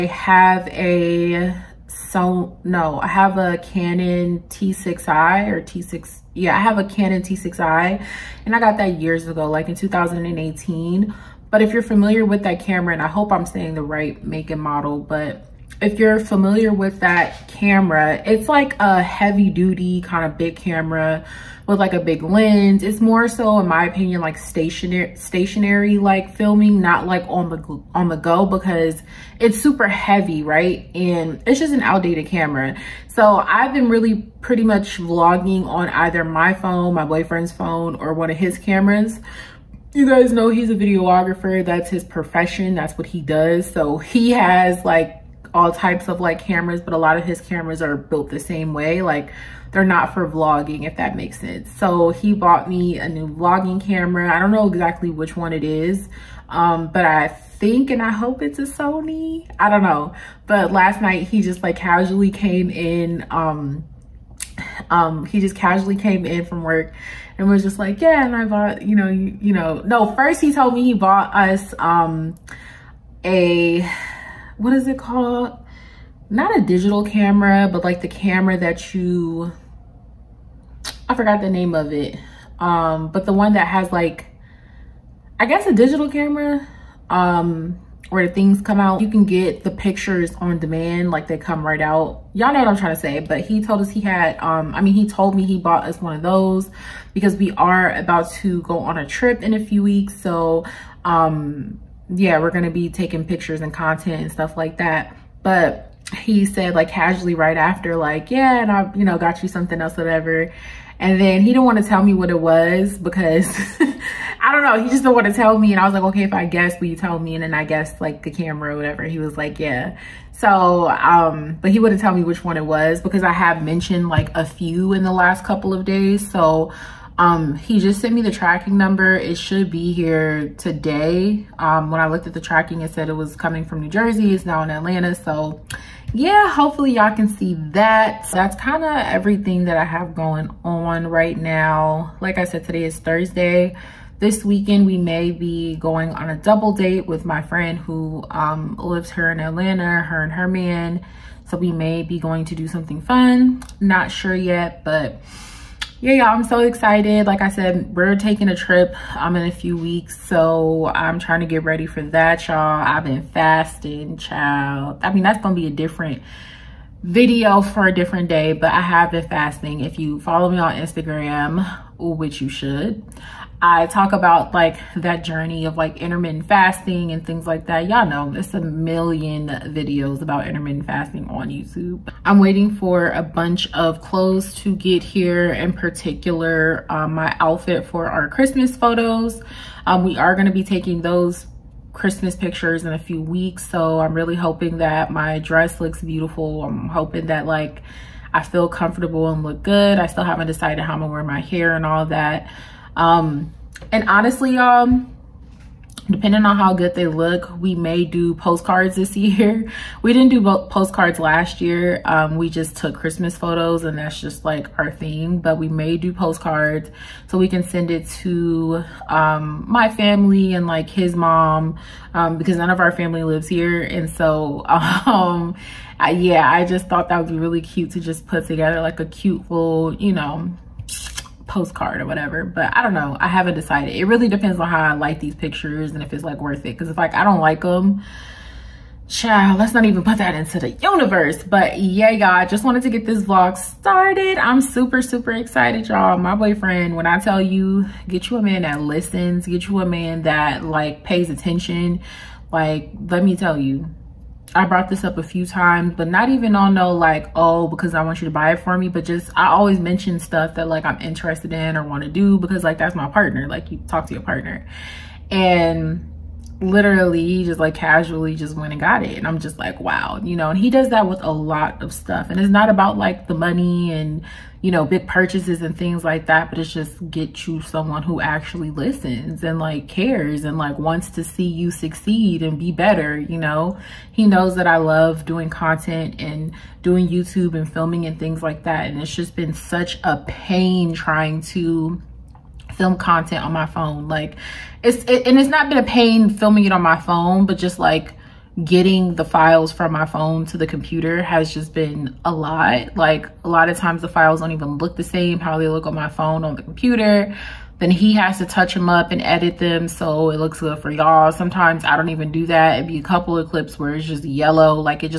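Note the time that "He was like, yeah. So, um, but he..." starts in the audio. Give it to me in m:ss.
1:59.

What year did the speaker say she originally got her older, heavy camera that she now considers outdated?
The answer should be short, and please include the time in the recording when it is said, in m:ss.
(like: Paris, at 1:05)
2018, at 0:09.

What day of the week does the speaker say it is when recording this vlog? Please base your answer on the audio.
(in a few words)
Thursday.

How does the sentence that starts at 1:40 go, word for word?
So um, yeah, we're gonna be taking pictures and content and stuff like that.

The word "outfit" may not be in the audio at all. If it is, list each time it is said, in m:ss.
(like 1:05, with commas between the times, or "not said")
3:07.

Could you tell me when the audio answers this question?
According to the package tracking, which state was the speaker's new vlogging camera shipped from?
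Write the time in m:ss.
2:13.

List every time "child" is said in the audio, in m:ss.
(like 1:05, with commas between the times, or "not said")
2:44, 3:59.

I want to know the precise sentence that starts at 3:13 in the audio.
So I'm really hoping that my dress looks beautiful.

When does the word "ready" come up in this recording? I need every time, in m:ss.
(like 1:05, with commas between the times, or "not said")
2:41.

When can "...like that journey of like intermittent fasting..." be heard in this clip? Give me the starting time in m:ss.
2:54.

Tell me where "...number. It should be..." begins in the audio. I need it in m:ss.
2:08.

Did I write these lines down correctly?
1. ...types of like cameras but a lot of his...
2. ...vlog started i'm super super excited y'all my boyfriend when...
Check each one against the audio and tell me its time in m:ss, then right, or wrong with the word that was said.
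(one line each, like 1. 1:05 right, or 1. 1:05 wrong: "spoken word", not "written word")
1. 0:45 right
2. 4:03 right.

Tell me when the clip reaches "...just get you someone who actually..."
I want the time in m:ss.
4:36.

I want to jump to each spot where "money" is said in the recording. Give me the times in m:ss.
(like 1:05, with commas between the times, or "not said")
4:33.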